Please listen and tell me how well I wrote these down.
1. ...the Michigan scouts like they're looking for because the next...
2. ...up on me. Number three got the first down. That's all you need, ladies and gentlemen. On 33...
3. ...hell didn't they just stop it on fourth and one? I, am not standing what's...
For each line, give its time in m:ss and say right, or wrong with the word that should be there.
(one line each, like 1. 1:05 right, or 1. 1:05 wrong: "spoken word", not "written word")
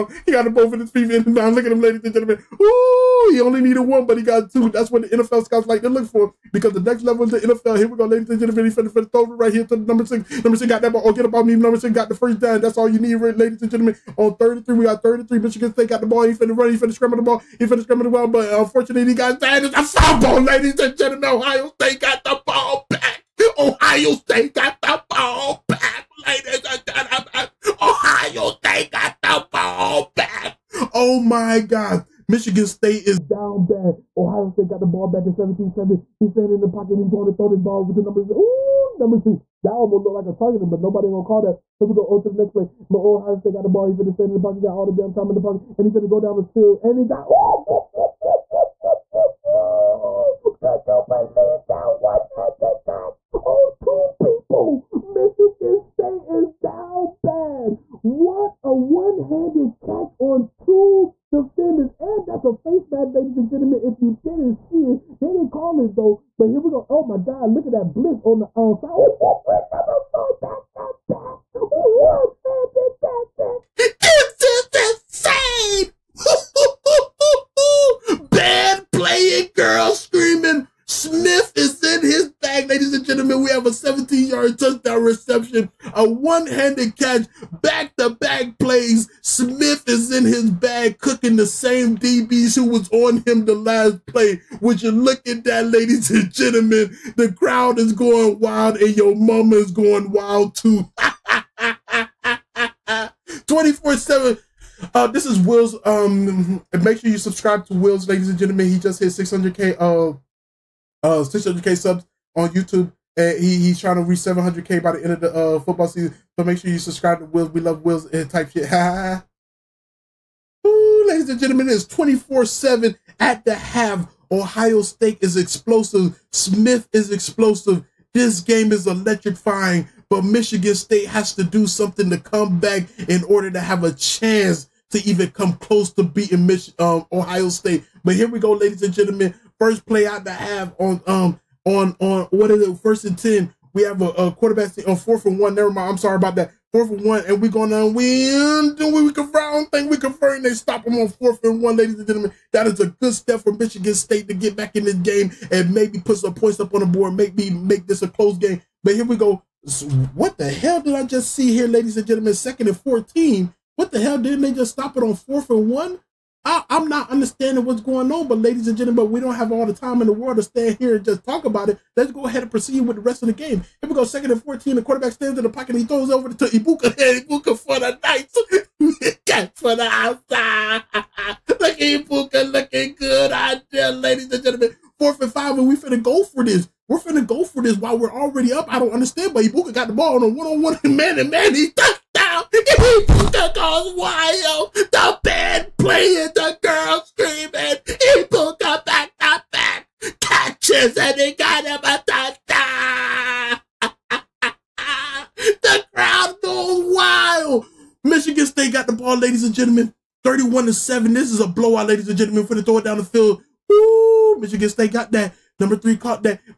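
1. 0:05 wrong: "NFL", not "Michigan"
2. 0:11 wrong: "six", not "three"
3. 2:43 wrong: "understanding", not "standing".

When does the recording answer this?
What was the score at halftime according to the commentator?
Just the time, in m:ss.
2:01.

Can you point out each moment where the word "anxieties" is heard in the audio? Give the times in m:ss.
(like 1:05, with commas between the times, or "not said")
not said.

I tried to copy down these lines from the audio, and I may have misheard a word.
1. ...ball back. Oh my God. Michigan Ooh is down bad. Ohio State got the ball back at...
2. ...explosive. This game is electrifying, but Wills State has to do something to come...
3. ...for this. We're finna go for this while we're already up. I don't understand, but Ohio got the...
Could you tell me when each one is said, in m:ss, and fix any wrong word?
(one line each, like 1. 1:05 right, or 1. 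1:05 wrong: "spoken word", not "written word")
1. 0:29 wrong: "State", not "Ooh"
2. 2:07 wrong: "Michigan", not "Wills"
3. 3:06 wrong: "Egbuka", not "Ohio".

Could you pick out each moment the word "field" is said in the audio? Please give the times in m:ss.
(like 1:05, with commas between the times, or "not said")
0:46, 3:33.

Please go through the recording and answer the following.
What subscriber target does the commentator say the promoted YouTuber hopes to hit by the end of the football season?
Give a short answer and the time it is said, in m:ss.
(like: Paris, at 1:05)
700K, at 1:54.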